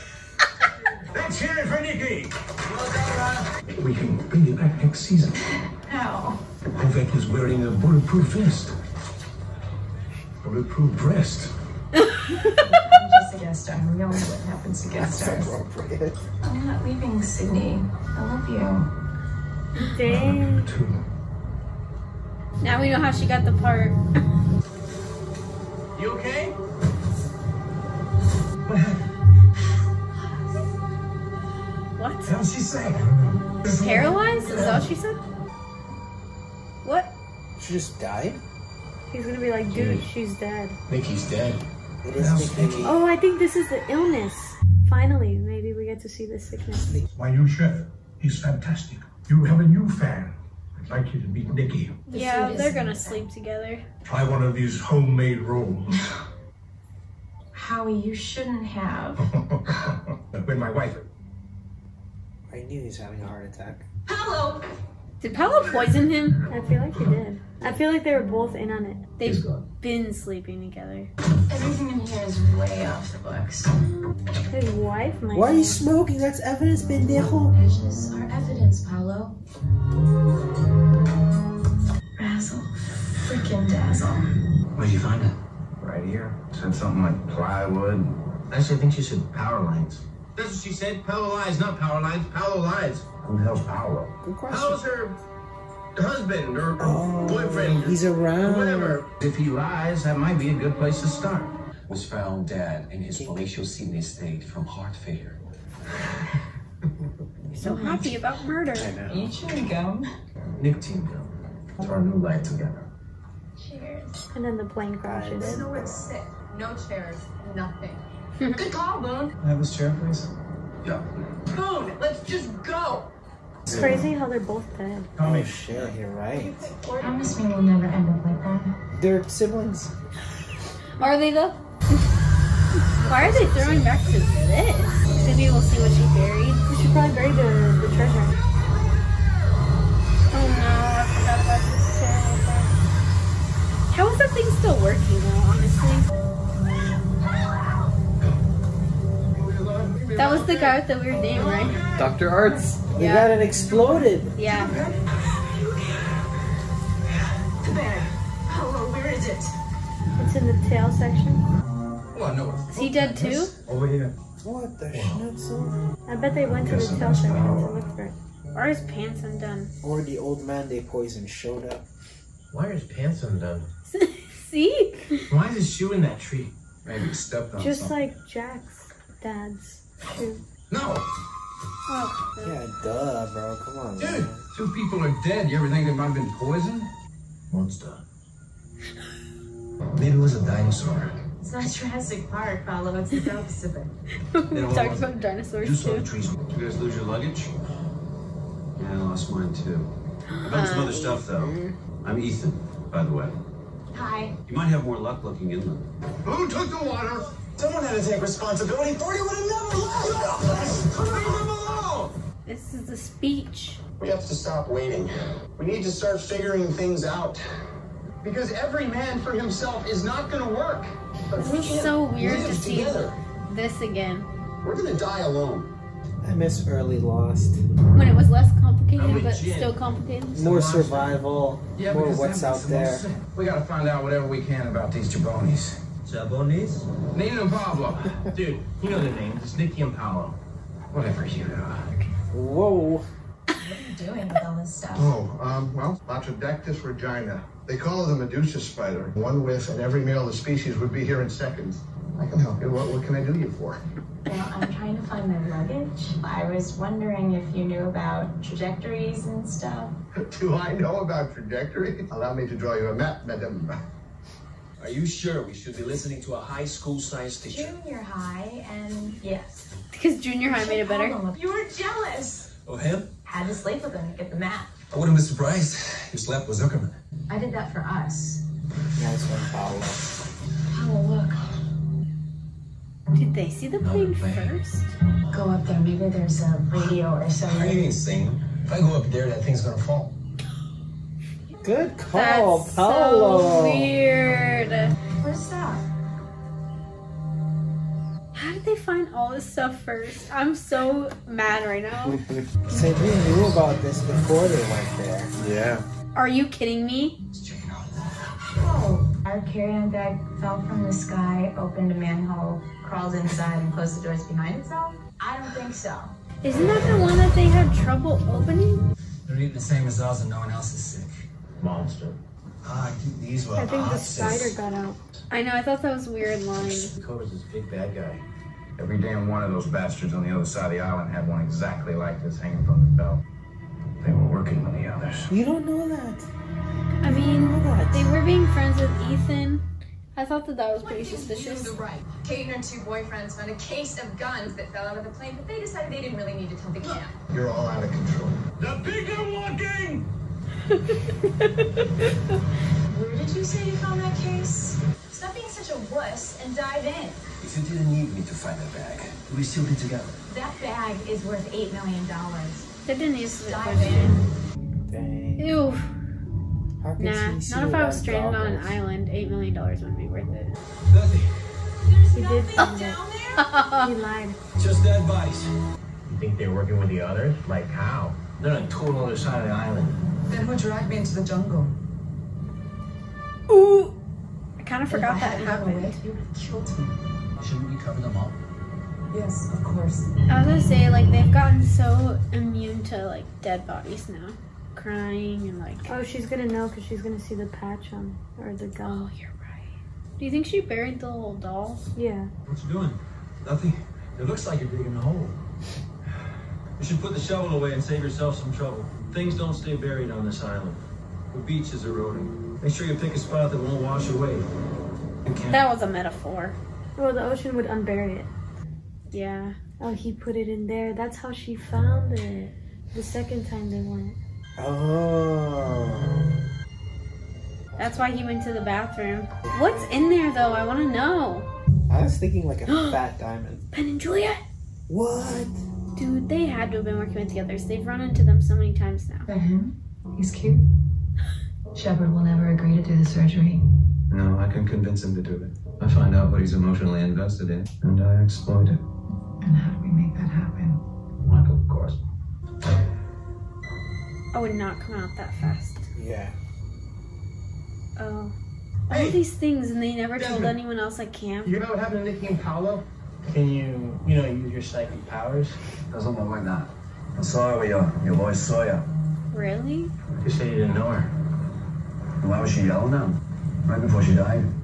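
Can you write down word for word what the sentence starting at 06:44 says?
It looks like you're digging a hole.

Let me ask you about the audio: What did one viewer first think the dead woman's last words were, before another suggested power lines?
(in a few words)
Plywood.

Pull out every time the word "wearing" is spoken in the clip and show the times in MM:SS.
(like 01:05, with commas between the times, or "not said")
00:07.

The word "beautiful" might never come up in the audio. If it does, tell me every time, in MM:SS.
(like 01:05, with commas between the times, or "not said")
not said.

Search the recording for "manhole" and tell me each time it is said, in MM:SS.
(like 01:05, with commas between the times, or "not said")
05:11.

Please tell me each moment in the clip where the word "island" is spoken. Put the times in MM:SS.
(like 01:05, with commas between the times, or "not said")
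05:30, 06:08, 06:19, 06:50.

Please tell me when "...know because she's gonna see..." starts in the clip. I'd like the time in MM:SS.
06:36.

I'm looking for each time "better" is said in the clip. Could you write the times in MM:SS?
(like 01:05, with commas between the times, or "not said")
04:30.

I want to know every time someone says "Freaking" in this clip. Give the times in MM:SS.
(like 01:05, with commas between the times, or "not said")
01:23.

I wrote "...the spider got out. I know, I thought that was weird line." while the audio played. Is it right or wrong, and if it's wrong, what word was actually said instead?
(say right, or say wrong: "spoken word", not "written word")
right.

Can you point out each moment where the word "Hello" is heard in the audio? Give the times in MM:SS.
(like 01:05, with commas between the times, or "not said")
01:04, 02:38.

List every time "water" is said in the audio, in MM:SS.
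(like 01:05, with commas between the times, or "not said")
03:26.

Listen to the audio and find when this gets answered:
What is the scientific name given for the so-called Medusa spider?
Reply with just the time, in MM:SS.
04:06.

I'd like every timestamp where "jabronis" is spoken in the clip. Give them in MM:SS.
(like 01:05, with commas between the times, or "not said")
03:55.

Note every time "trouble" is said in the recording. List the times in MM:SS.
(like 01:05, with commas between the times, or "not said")
05:17, 06:48.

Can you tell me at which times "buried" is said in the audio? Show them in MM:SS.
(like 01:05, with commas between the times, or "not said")
02:16, 06:40, 06:49.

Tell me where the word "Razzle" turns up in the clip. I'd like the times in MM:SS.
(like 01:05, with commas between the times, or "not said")
01:22.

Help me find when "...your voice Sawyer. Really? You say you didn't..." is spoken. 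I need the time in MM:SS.
07:48.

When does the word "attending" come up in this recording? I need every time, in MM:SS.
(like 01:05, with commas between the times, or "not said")
not said.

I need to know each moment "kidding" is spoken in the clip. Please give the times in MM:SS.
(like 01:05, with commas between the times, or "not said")
05:06.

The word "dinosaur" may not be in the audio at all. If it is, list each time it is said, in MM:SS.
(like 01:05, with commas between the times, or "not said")
03:10, 03:15.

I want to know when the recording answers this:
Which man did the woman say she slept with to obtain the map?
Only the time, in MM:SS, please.
04:36.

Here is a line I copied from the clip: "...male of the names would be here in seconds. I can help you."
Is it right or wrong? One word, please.
wrong.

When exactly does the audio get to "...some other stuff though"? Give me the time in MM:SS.
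03:20.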